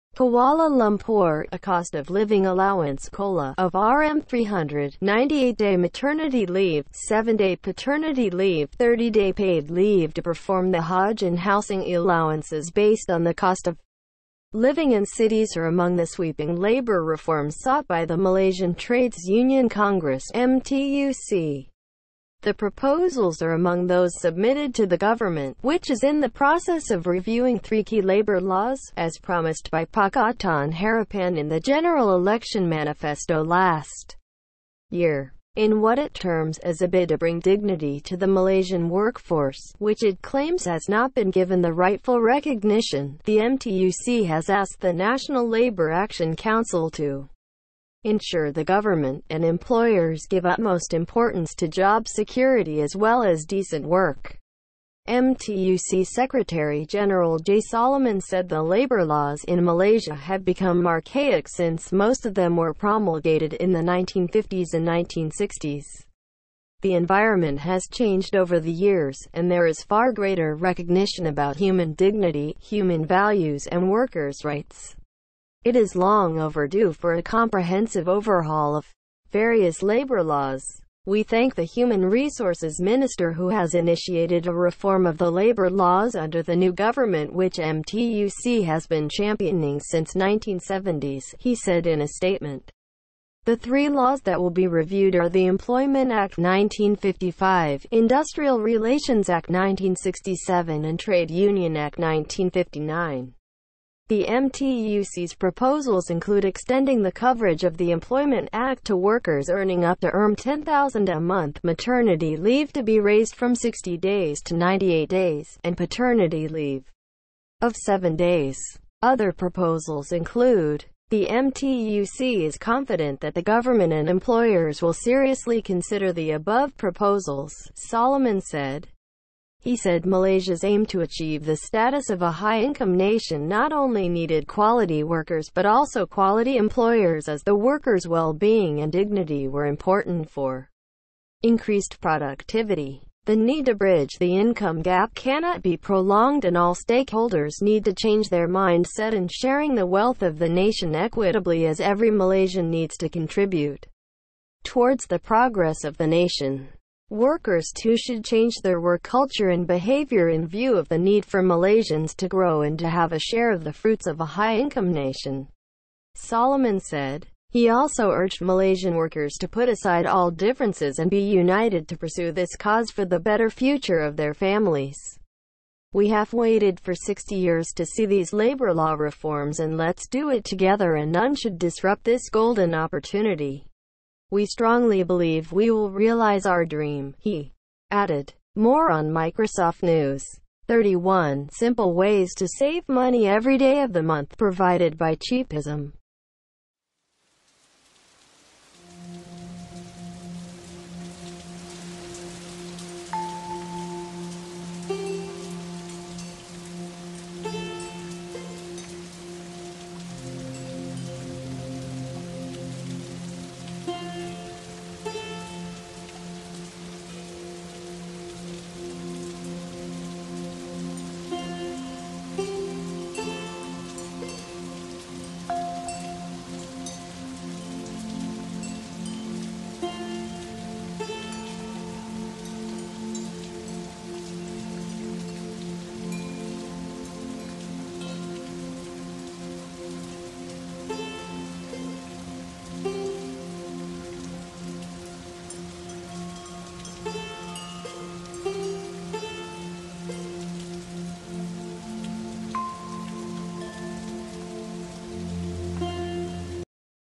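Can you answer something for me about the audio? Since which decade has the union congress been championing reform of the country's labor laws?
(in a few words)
1970s.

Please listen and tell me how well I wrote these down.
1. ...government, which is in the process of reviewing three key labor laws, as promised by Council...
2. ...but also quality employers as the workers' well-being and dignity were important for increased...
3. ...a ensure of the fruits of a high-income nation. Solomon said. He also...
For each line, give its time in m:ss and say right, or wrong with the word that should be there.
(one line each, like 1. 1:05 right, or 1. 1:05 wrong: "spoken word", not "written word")
1. 0:24 wrong: "Pakatan", not "Council"
2. 2:15 right
3. 2:43 wrong: "share", not "ensure".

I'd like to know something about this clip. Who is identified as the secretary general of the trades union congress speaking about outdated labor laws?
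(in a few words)
Jay Solomon.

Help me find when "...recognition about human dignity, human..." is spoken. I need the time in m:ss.
1:10.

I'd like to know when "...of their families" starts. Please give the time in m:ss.
2:53.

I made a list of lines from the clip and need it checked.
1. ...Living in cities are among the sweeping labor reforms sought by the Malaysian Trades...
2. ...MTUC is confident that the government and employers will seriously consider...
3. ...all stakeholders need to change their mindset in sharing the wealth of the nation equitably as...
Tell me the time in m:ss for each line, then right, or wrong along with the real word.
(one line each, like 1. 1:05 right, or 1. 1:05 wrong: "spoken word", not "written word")
1. 0:14 right
2. 2:01 right
3. 2:26 right.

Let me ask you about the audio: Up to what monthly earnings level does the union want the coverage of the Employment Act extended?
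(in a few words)
10000.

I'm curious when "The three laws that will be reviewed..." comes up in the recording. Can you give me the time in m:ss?
1:33.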